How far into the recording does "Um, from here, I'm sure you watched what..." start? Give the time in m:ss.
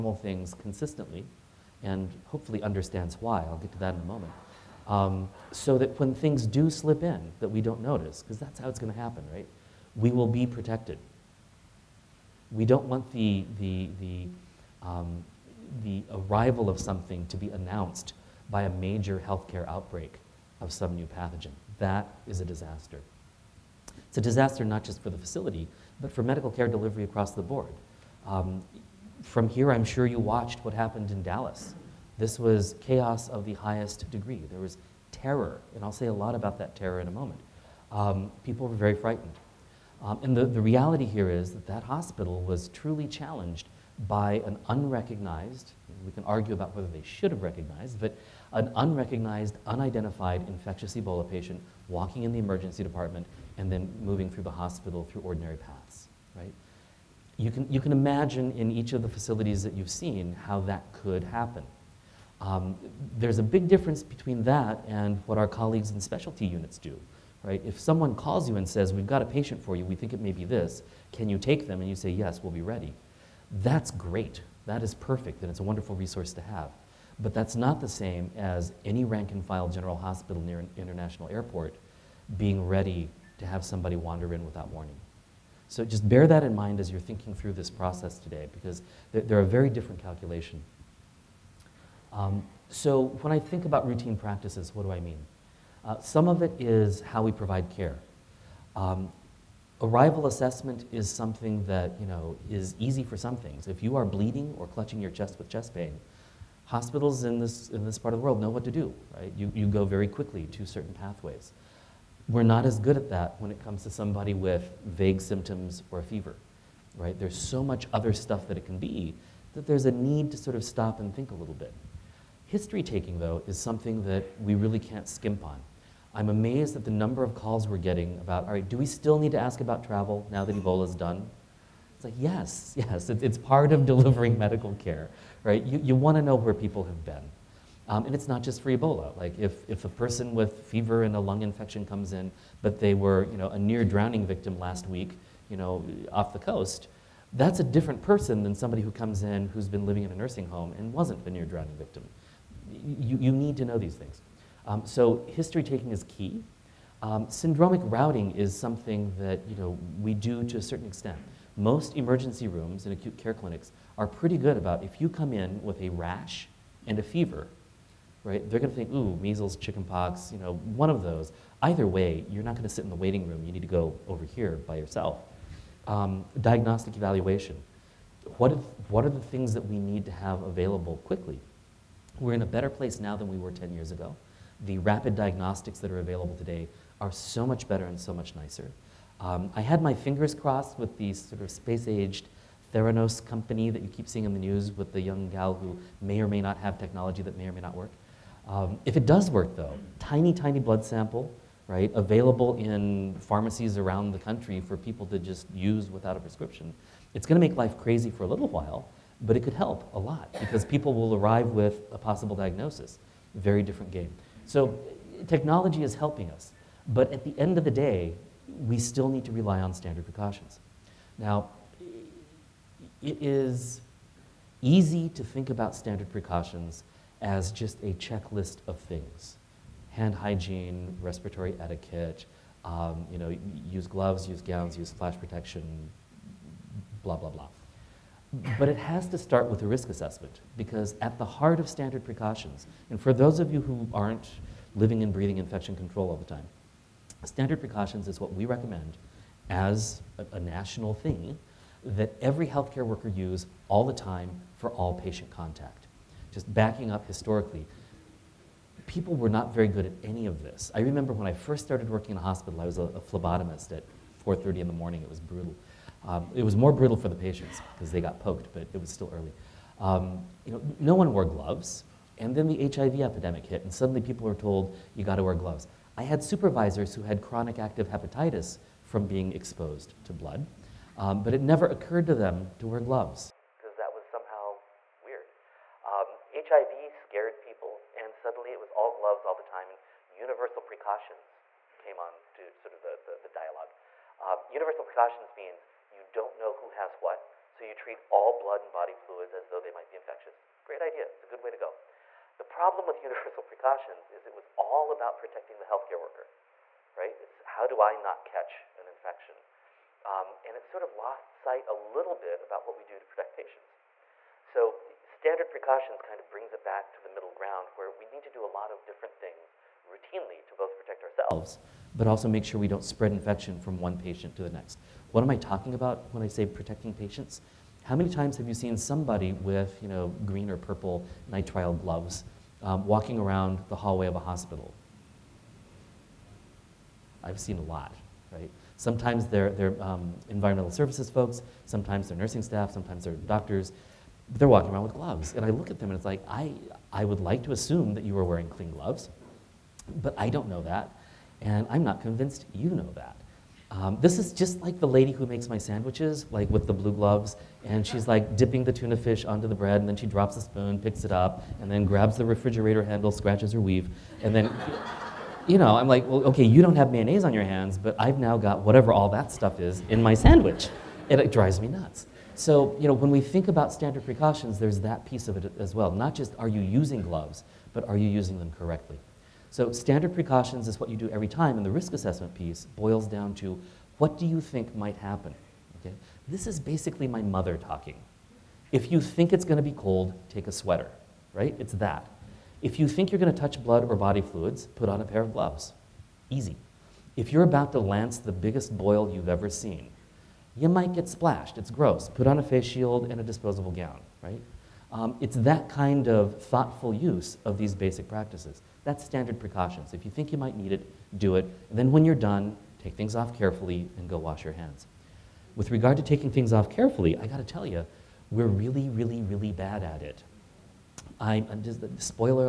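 0:28.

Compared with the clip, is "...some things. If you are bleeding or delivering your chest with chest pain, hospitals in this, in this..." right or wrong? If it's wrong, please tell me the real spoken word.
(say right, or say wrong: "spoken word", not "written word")
wrong: "clutching", not "delivering".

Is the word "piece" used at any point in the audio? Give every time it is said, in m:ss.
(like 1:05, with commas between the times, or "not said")
6:15, 6:22.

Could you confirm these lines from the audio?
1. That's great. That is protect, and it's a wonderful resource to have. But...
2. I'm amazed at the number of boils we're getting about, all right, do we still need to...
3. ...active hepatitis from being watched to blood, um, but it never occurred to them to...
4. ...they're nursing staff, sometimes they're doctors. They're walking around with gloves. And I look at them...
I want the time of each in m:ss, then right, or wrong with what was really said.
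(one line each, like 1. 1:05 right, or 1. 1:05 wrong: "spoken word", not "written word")
1. 1:13 wrong: "perfect", not "protect"
2. 2:06 wrong: "calls", not "boils"
3. 4:37 wrong: "exposed", not "watched"
4. 5:42 right.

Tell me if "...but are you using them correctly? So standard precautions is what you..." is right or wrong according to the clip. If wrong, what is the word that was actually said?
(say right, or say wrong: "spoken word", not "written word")
right.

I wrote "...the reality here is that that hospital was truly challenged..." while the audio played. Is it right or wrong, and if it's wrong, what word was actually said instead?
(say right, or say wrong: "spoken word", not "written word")
right.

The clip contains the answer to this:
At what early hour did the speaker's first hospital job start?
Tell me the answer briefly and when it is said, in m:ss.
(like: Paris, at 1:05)
4:30, at 4:24.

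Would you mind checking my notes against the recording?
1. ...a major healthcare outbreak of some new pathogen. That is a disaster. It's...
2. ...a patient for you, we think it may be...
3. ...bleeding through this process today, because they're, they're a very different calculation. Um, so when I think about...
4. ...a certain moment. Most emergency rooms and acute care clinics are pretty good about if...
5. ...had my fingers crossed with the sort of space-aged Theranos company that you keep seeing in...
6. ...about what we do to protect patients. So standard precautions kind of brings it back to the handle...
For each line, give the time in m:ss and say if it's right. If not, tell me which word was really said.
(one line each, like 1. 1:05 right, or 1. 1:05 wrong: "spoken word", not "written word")
1. 0:18 right
2. 1:09 right
3. 1:26 wrong: "thinking", not "bleeding"
4. 2:40 wrong: "extent", not "moment"
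5. 3:09 right
6. 5:12 wrong: "middle", not "handle".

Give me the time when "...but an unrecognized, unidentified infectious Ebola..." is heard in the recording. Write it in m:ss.
0:47.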